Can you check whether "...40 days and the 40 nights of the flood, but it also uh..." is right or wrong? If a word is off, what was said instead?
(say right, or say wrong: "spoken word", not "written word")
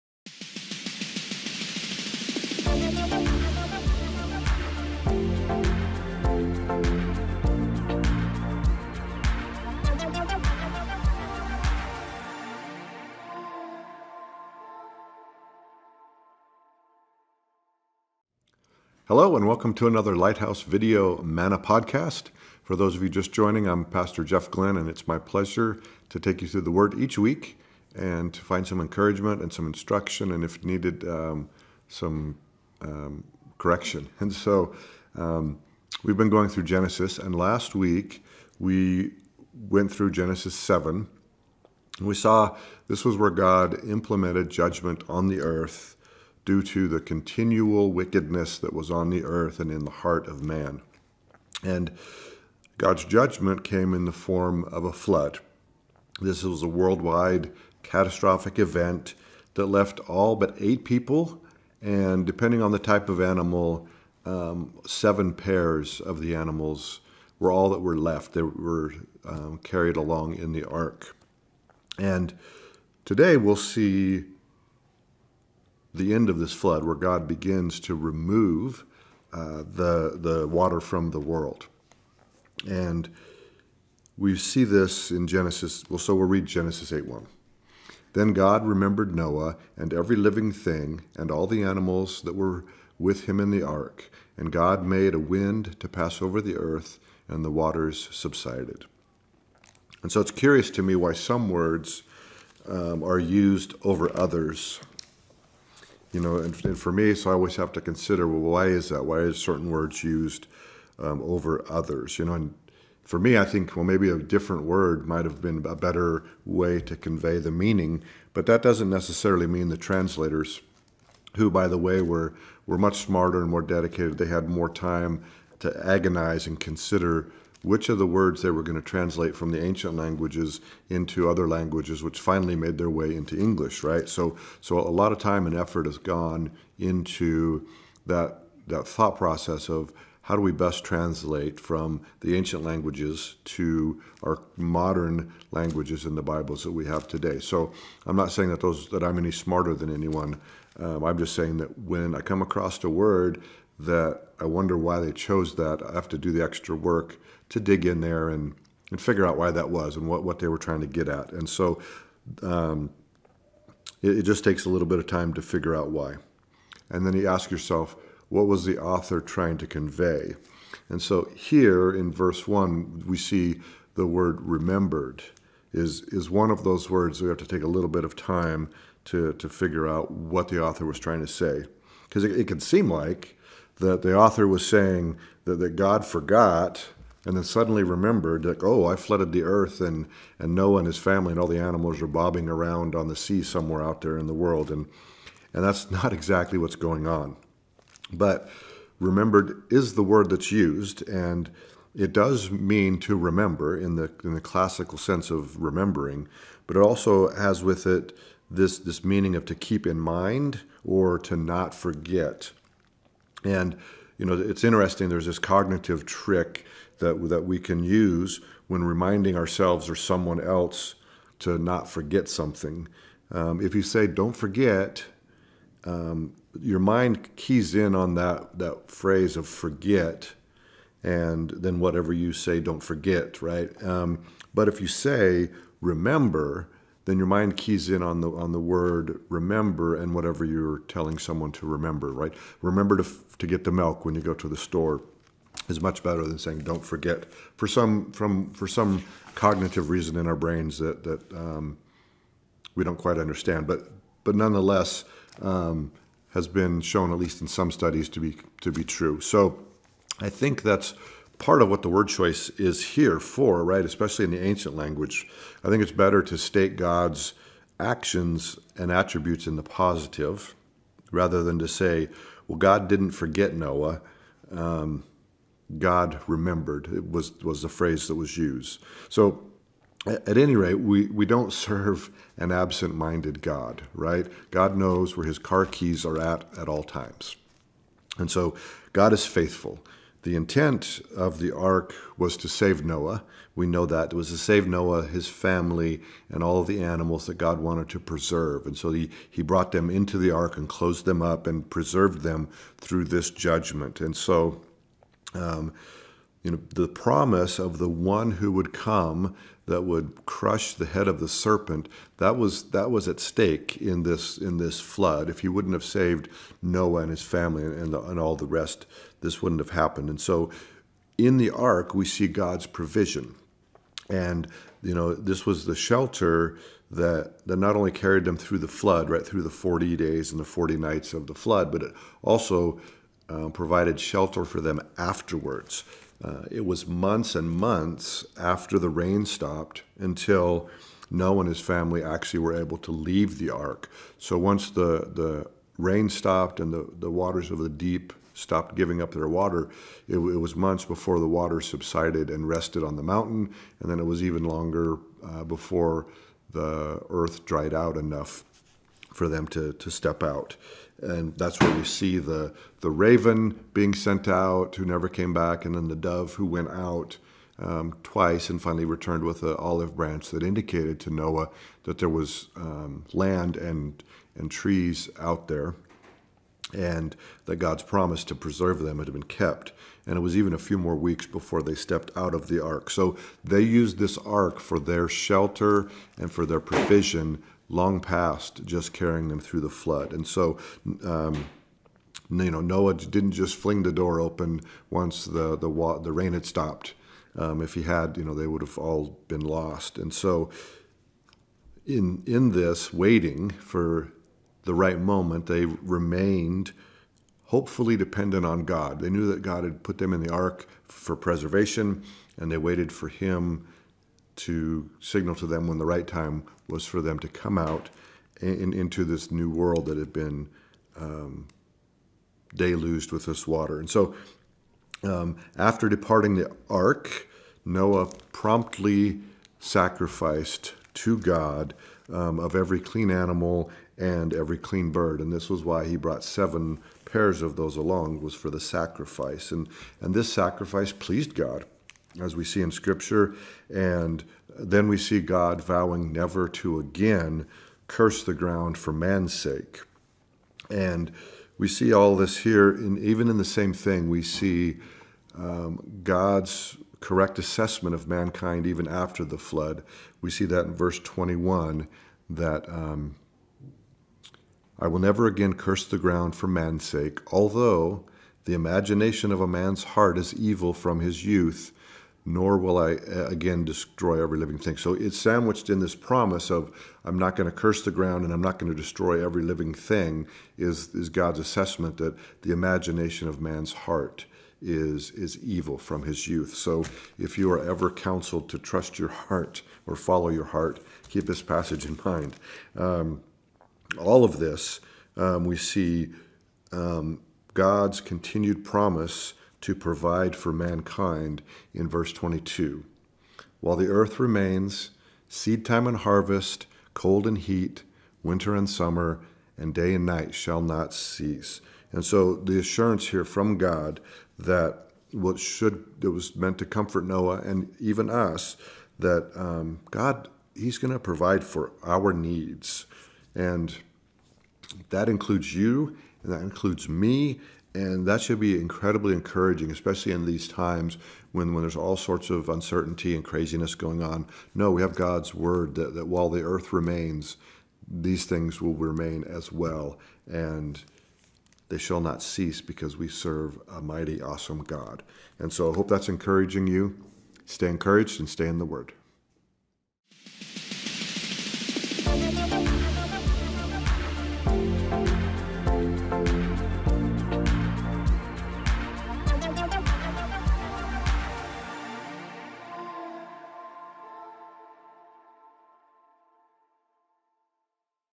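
right.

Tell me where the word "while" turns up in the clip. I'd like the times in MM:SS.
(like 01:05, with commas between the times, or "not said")
08:23, 08:56.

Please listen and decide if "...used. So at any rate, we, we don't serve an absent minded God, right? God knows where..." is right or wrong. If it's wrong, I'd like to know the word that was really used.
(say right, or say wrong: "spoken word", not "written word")
right.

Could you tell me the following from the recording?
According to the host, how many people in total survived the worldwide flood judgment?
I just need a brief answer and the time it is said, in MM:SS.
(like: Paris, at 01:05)
8, at 01:00.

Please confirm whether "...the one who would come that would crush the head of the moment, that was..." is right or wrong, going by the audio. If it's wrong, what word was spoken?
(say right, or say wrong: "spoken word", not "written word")
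wrong: "serpent", not "moment".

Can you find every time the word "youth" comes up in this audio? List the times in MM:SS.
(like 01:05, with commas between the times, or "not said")
07:51, 08:06.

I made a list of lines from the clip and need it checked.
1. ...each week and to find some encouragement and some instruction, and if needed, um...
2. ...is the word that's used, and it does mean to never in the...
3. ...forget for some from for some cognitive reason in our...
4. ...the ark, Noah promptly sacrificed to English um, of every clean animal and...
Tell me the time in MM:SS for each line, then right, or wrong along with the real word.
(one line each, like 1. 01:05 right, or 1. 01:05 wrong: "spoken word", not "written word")
1. 00:26 right
2. 03:19 wrong: "remember", not "never"
3. 04:06 right
4. 07:06 wrong: "God", not "English".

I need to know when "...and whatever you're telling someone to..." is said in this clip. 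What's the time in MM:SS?
03:59.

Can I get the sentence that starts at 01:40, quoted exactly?
And so it's curious to me why some words um, are used over others.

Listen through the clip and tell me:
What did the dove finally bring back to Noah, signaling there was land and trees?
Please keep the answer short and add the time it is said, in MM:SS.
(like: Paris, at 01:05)
An olive branch, at 06:09.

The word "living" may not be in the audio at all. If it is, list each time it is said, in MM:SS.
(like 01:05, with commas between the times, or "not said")
01:30, 07:54, 07:59.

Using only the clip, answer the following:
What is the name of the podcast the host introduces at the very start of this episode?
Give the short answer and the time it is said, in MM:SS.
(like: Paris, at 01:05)
Lighthouse Video Manna, at 00:20.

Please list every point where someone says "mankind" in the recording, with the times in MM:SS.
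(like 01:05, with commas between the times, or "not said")
07:38, 08:20.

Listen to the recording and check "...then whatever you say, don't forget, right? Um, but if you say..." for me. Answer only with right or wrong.
right.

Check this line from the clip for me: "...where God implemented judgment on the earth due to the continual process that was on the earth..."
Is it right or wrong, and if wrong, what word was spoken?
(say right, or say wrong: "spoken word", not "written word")
wrong: "wickedness", not "process".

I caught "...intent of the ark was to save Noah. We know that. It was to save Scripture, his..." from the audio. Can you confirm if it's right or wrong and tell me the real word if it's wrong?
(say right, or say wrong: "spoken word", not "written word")
wrong: "Noah", not "Scripture".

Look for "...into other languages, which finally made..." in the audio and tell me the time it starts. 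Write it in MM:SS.
02:10.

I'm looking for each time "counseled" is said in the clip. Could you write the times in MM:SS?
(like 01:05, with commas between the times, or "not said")
08:07.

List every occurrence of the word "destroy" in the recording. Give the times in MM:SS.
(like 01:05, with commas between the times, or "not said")
07:53, 07:58.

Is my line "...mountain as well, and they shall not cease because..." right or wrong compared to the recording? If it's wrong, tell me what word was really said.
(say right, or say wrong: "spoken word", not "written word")
wrong: "remain", not "mountain".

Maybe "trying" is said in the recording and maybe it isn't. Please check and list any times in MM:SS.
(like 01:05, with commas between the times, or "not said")
02:40, 02:49, 03:00.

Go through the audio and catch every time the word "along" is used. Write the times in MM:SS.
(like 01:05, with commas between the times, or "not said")
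01:09, 07:17.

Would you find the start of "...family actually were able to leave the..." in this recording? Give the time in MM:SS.
05:41.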